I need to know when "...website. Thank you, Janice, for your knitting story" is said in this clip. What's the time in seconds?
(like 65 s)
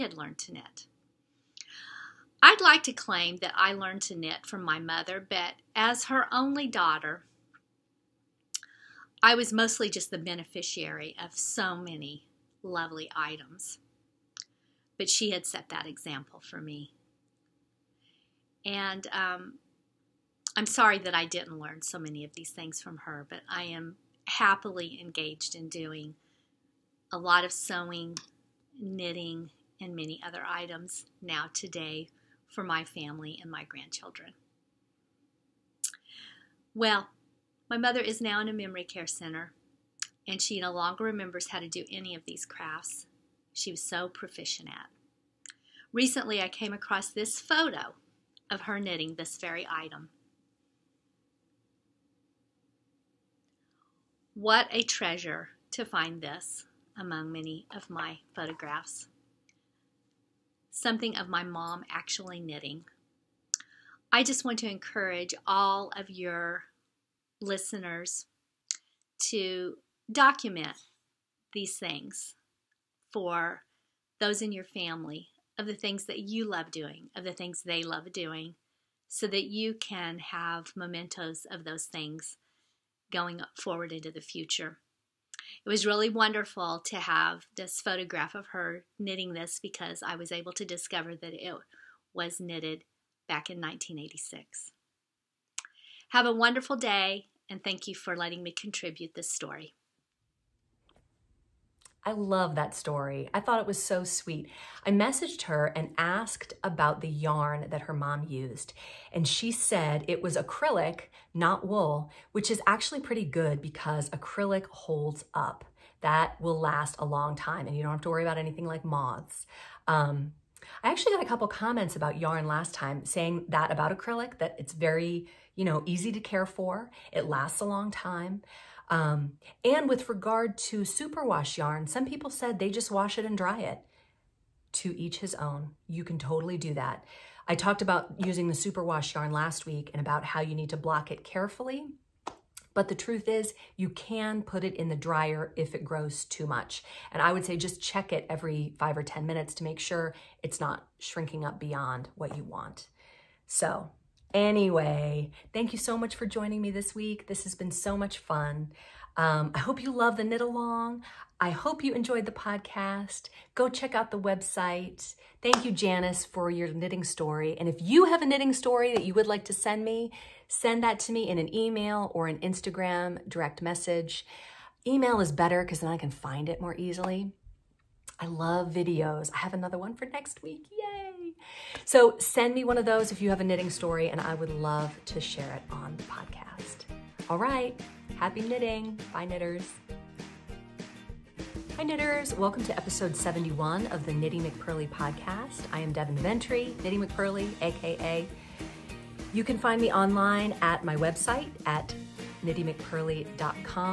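164 s.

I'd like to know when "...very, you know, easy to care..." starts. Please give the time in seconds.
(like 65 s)
124 s.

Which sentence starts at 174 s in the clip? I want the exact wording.
Email is better because then I can find it more easily.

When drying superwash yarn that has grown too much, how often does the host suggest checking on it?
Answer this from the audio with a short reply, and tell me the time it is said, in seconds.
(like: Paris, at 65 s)
Every 5 or 10 minutes, at 148 s.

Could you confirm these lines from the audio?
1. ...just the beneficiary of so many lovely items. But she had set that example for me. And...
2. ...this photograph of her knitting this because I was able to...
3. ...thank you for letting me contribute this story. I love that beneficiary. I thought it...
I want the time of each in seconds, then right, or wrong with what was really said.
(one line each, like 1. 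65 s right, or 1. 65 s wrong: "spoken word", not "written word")
1. 9 s right
2. 87 s right
3. 97 s wrong: "story", not "beneficiary".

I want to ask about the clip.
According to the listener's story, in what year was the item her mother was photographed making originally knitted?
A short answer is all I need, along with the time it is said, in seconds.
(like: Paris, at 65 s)
1986, at 93 s.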